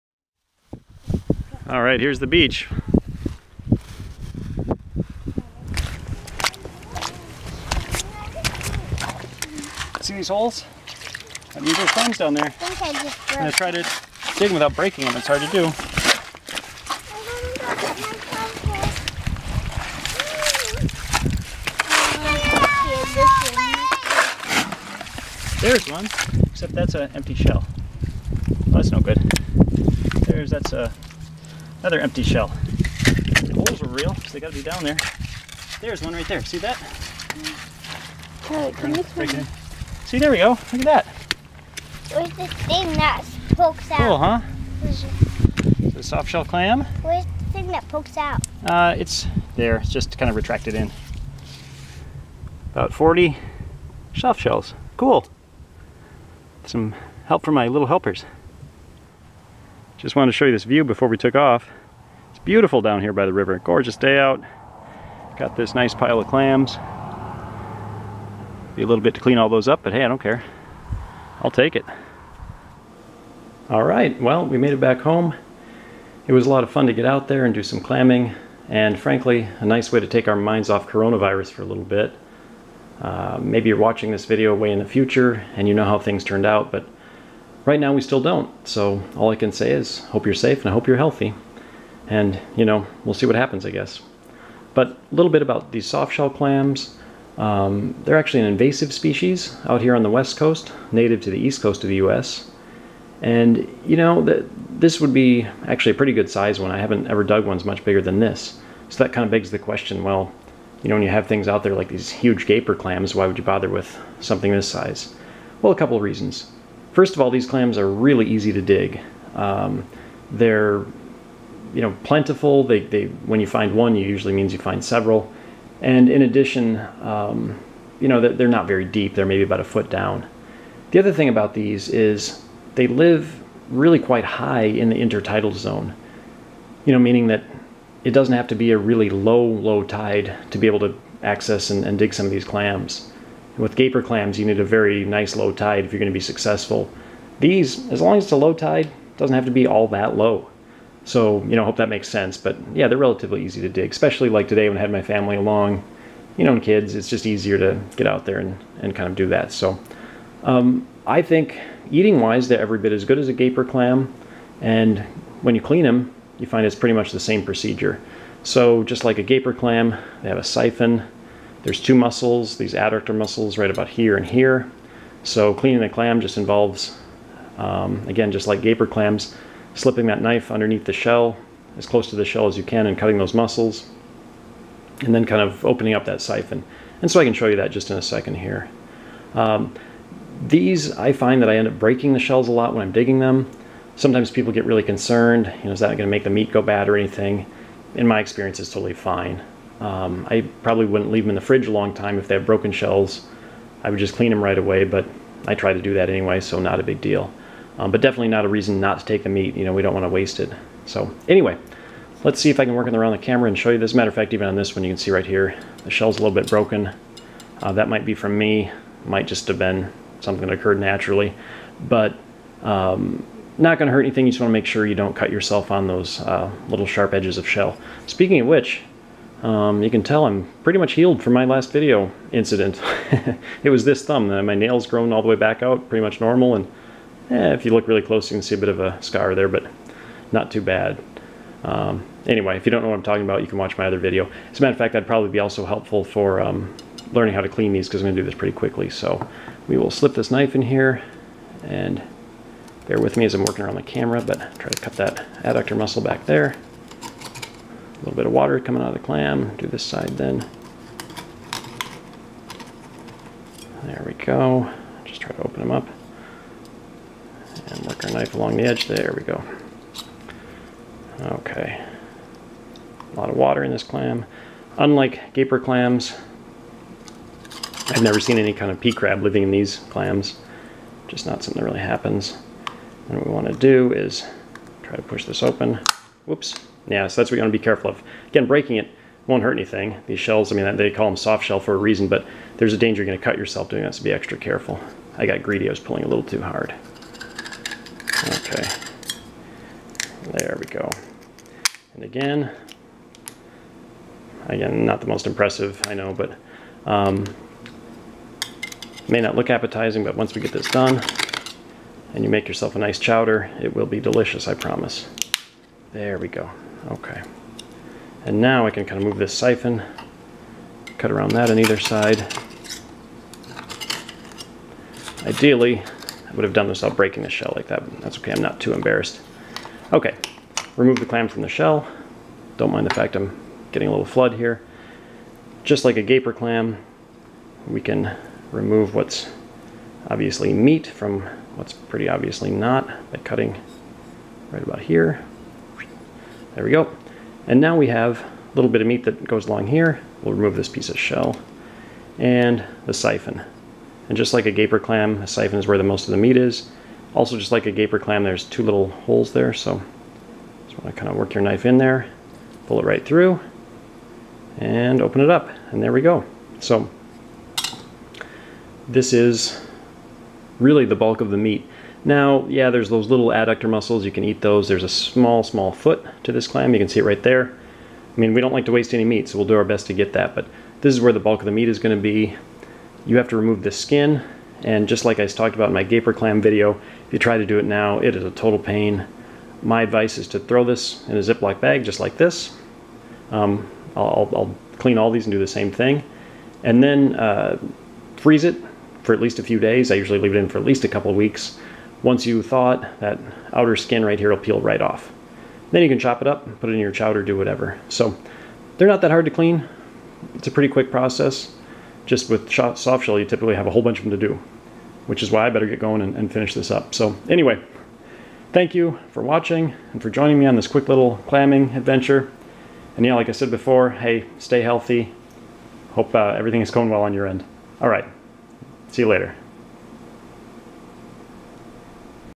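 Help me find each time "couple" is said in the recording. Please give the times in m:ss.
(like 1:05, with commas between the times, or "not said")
1:55, 6:40.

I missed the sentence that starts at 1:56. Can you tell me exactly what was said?
First of all, these clams are really easy to dig.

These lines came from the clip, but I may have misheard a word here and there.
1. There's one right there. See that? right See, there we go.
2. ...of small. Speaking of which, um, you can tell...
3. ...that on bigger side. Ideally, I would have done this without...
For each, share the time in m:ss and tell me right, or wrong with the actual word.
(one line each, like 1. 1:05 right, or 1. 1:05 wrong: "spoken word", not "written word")
1. 0:35 right
2. 3:47 wrong: "shell", not "small"
3. 5:21 wrong: "either", not "bigger".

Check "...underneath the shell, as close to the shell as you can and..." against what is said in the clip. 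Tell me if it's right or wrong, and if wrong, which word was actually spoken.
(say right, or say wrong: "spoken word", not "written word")
right.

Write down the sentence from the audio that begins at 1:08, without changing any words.
Be a little bit to clean all those up, but hey, I don't care.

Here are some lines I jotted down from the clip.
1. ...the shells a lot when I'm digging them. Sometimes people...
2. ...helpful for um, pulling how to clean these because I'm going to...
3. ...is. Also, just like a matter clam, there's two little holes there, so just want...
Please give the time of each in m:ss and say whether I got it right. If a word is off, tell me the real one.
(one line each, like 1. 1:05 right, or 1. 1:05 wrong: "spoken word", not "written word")
1. 3:12 right
2. 4:05 wrong: "learning", not "pulling"
3. 5:56 wrong: "gaper", not "matter".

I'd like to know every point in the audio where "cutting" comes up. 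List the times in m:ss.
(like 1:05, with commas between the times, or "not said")
3:02, 5:43.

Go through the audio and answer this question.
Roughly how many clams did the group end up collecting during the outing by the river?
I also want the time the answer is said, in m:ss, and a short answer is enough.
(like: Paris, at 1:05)
40, at 0:52.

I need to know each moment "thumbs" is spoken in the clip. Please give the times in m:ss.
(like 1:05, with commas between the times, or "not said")
0:11, 3:54.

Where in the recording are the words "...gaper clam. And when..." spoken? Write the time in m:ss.
2:43.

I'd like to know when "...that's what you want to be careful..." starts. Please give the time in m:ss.
4:47.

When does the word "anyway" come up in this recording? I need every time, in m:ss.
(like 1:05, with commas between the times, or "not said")
3:26, 3:31, 4:02, 6:57.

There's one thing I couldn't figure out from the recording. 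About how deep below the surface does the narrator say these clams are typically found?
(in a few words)
About a foot.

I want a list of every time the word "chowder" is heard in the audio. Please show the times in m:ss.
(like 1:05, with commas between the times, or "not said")
5:12, 6:46.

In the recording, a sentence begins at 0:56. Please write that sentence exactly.
Some help from my little helpers.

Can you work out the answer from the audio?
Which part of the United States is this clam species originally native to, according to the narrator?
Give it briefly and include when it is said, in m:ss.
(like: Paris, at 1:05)
East coast, at 1:41.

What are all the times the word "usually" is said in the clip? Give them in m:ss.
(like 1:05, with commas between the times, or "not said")
2:04, 6:39.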